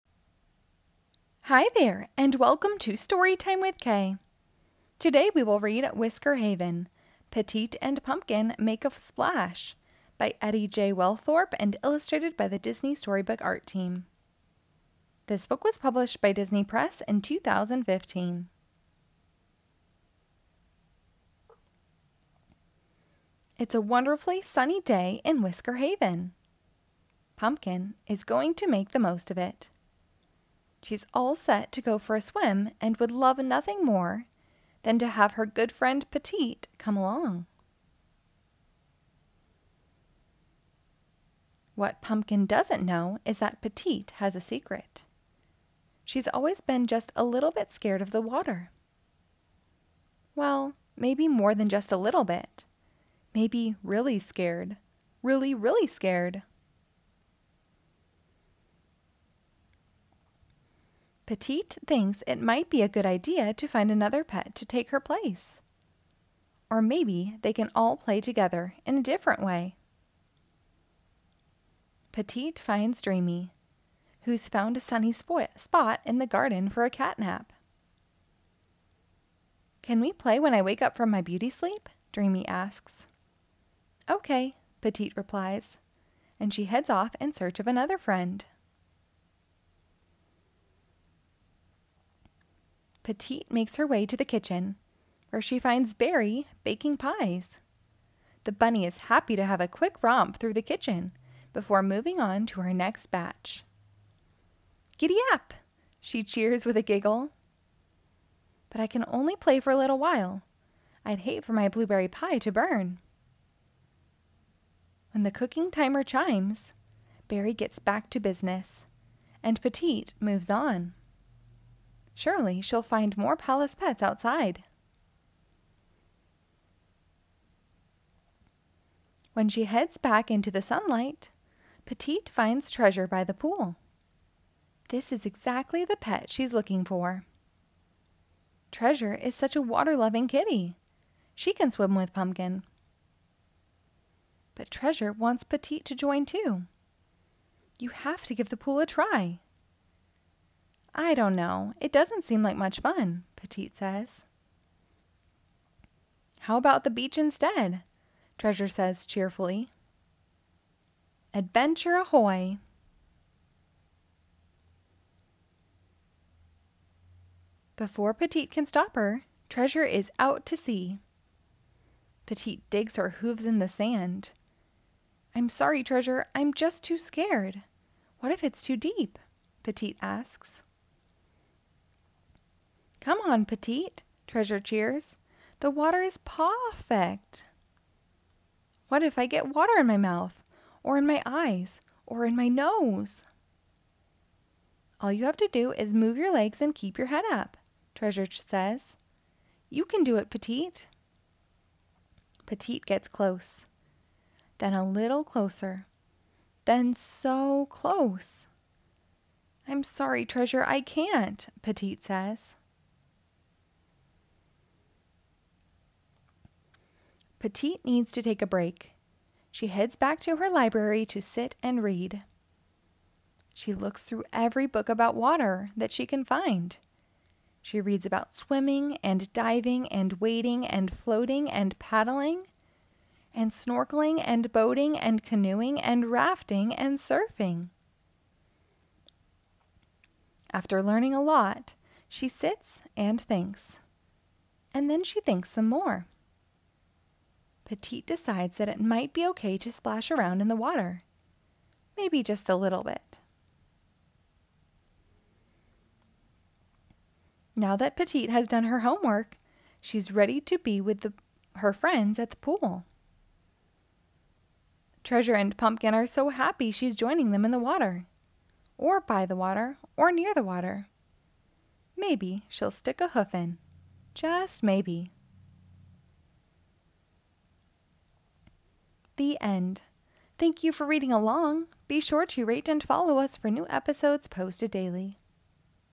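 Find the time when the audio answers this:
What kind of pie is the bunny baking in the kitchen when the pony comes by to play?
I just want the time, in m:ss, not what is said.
1:51.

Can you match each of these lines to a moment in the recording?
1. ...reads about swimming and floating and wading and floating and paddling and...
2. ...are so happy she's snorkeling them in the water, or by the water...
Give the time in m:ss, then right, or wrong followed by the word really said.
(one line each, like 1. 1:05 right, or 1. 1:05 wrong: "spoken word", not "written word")
1. 3:47 wrong: "diving", not "floating"
2. 4:25 wrong: "joining", not "snorkeling".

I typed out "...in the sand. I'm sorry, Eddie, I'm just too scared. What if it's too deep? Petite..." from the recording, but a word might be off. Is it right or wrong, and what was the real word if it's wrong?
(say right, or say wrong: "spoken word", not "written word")
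wrong: "Treasure", not "Eddie".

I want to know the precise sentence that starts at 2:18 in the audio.
Treasure is such a water loving kitty.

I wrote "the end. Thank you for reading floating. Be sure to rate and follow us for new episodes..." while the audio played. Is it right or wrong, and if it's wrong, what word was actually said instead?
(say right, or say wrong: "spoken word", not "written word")
wrong: "along", not "floating".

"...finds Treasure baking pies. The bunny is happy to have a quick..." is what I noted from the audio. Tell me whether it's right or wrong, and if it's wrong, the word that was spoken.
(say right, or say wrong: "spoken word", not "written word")
wrong: "Berry", not "Treasure".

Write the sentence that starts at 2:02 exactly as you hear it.
Surely she'll find more palace pets outside.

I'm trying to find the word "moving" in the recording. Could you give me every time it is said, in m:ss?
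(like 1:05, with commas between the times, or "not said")
1:41.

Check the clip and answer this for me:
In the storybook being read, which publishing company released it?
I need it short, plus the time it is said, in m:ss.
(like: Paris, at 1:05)
Disney Press, at 0:16.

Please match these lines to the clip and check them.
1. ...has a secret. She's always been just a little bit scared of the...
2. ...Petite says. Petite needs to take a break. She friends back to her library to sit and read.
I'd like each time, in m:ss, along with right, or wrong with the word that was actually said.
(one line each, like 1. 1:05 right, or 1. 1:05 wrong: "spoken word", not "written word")
1. 0:44 right
2. 3:31 wrong: "heads", not "friends".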